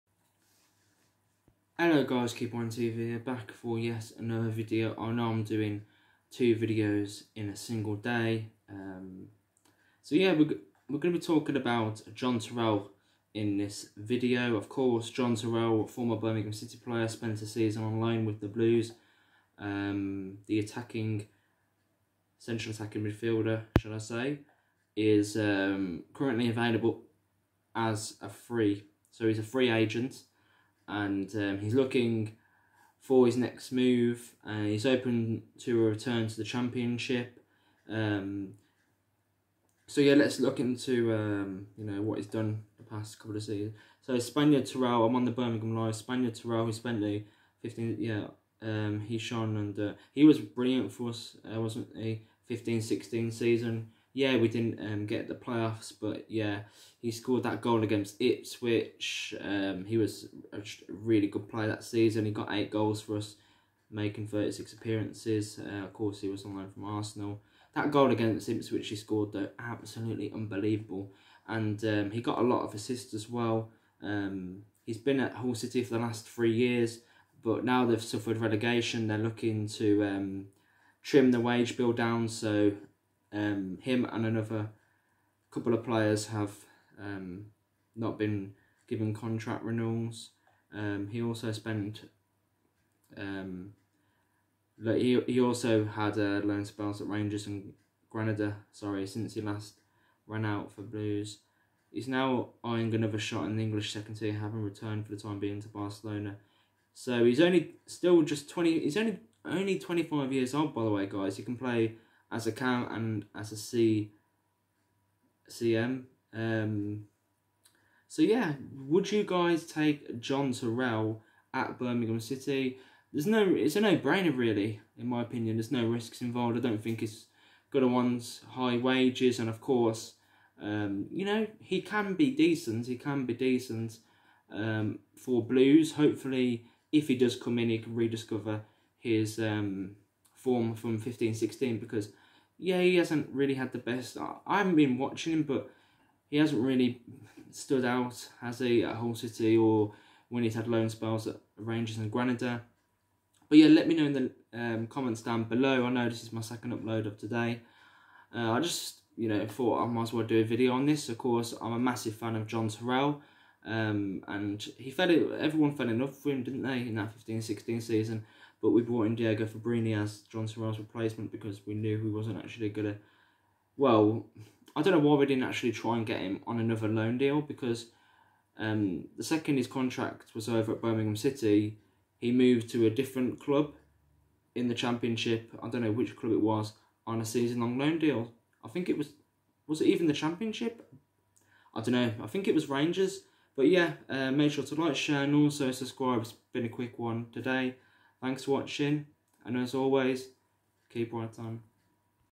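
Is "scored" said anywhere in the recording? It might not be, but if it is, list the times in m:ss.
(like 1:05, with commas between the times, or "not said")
0:57, 1:08.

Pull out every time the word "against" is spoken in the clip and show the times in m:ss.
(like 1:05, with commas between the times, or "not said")
0:57, 1:08.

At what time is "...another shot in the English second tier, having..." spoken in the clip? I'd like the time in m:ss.
1:42.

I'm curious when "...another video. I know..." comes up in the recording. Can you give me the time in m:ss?
0:04.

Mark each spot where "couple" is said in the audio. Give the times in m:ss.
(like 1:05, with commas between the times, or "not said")
0:43, 1:25.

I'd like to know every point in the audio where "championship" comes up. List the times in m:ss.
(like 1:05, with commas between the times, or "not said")
0:36, 3:04, 3:10.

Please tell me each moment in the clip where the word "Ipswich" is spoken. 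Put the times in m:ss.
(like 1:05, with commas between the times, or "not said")
0:58, 1:08.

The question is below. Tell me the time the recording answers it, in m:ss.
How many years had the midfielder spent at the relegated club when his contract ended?
1:16.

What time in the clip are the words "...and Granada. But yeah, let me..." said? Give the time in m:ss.
2:31.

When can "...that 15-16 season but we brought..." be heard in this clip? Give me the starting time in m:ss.
2:46.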